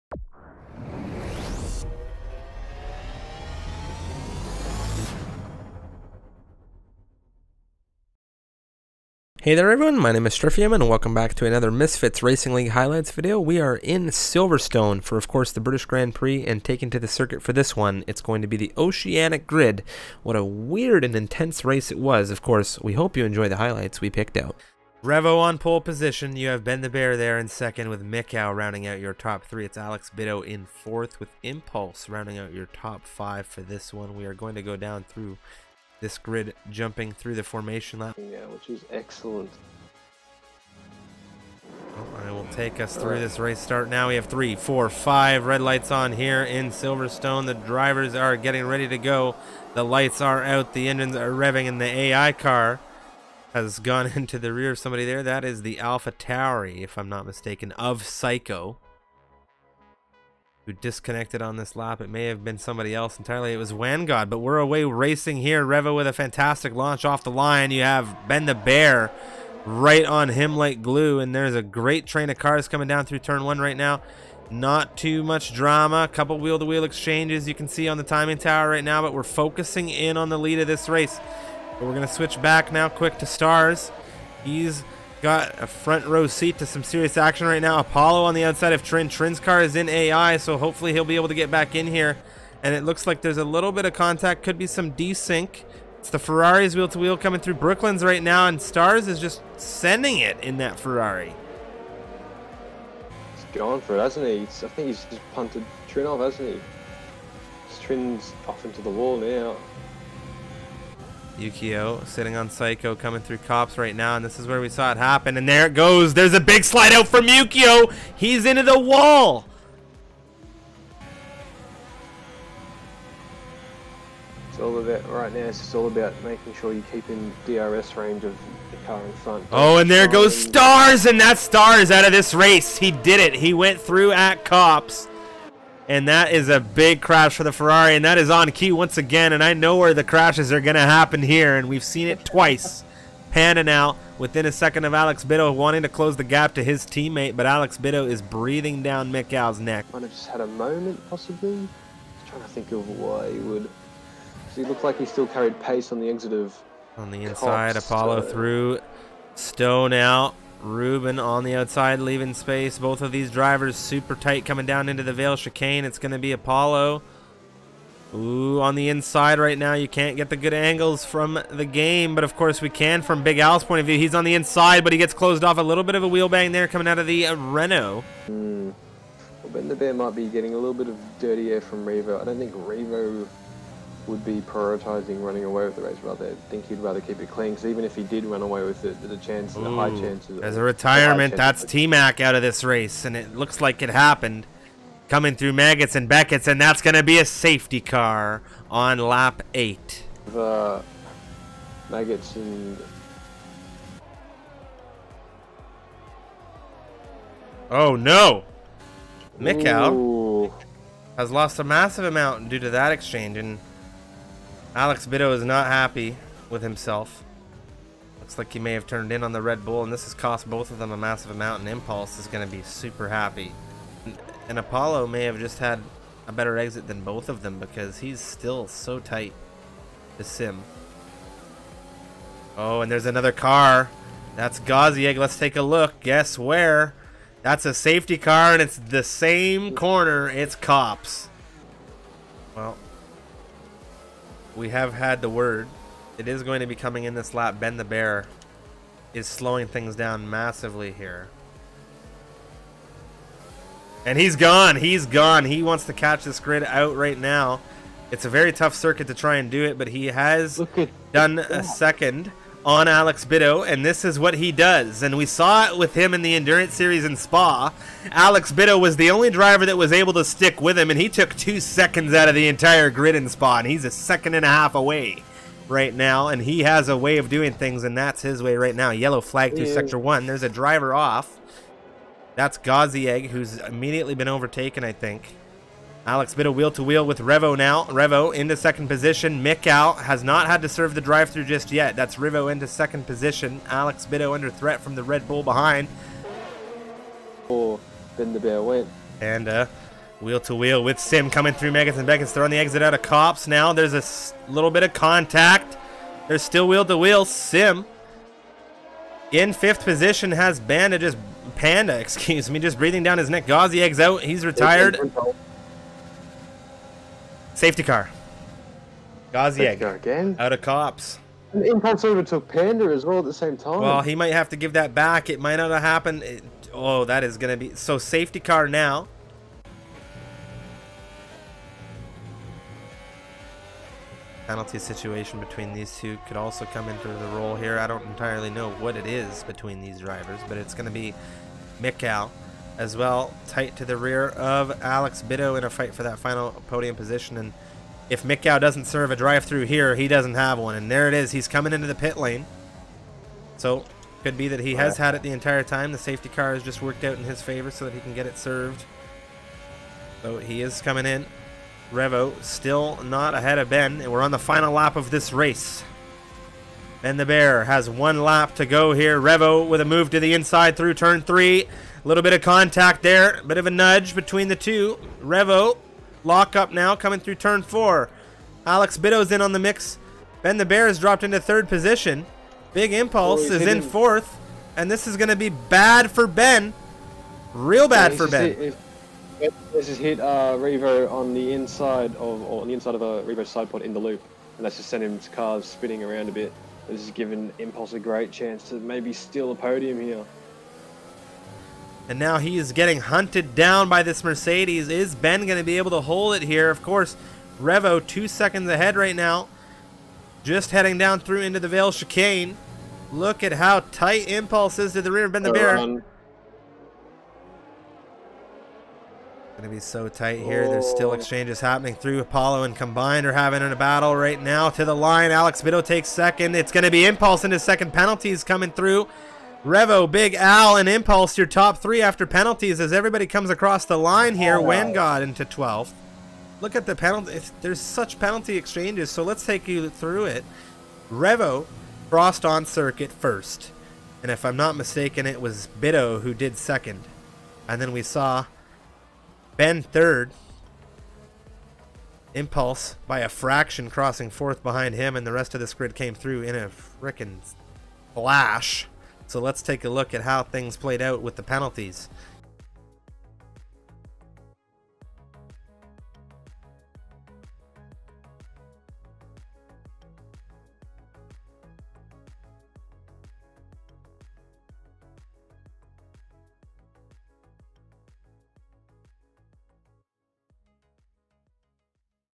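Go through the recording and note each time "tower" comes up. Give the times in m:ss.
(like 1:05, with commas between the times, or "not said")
1:18.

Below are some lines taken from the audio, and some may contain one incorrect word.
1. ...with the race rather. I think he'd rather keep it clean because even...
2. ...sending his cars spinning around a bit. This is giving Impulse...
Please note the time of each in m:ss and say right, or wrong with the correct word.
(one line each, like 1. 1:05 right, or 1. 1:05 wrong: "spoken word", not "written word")
1. 3:05 right
2. 6:34 right.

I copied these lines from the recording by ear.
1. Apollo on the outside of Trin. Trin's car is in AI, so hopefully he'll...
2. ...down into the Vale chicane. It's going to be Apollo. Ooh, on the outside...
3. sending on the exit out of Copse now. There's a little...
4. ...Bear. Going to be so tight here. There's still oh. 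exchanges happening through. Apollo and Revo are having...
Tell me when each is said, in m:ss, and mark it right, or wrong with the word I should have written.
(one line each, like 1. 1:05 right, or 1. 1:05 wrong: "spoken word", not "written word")
1. 1:27 right
2. 2:44 wrong: "inside", not "outside"
3. 5:02 wrong: "throwing", not "sending"
4. 6:55 wrong: "Combined", not "Revo".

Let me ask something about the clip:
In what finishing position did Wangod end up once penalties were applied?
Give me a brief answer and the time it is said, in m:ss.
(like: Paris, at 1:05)
12th, at 7:15.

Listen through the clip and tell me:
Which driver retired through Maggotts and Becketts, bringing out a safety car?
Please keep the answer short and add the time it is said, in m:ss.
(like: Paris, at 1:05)
T Mac, at 3:11.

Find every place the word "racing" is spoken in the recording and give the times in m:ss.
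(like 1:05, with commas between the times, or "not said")
0:12, 1:04.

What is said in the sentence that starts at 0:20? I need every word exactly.
What a weird and intense race it was.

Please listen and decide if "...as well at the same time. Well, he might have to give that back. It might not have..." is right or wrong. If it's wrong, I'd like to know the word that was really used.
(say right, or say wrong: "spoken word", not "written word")
right.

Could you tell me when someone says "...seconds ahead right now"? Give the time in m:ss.
6:48.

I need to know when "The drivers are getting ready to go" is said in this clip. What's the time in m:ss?
0:47.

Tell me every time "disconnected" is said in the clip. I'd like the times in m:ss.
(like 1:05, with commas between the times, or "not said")
1:00.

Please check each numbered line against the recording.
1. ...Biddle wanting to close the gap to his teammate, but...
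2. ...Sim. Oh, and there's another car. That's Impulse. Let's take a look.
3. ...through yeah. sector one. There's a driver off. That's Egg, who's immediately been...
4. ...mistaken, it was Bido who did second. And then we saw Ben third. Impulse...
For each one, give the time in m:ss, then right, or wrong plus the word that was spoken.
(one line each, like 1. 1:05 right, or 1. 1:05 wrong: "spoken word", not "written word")
1. 2:25 right
2. 3:50 wrong: "Gazieg", not "Impulse"
3. 4:39 right
4. 7:24 right.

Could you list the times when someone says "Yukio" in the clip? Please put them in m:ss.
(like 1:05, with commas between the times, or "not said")
1:51, 1:57.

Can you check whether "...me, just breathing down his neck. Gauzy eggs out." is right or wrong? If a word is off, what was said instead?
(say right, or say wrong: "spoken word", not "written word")
right.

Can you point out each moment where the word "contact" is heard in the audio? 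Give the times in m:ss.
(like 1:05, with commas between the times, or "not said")
1:33, 5:04, 6:12.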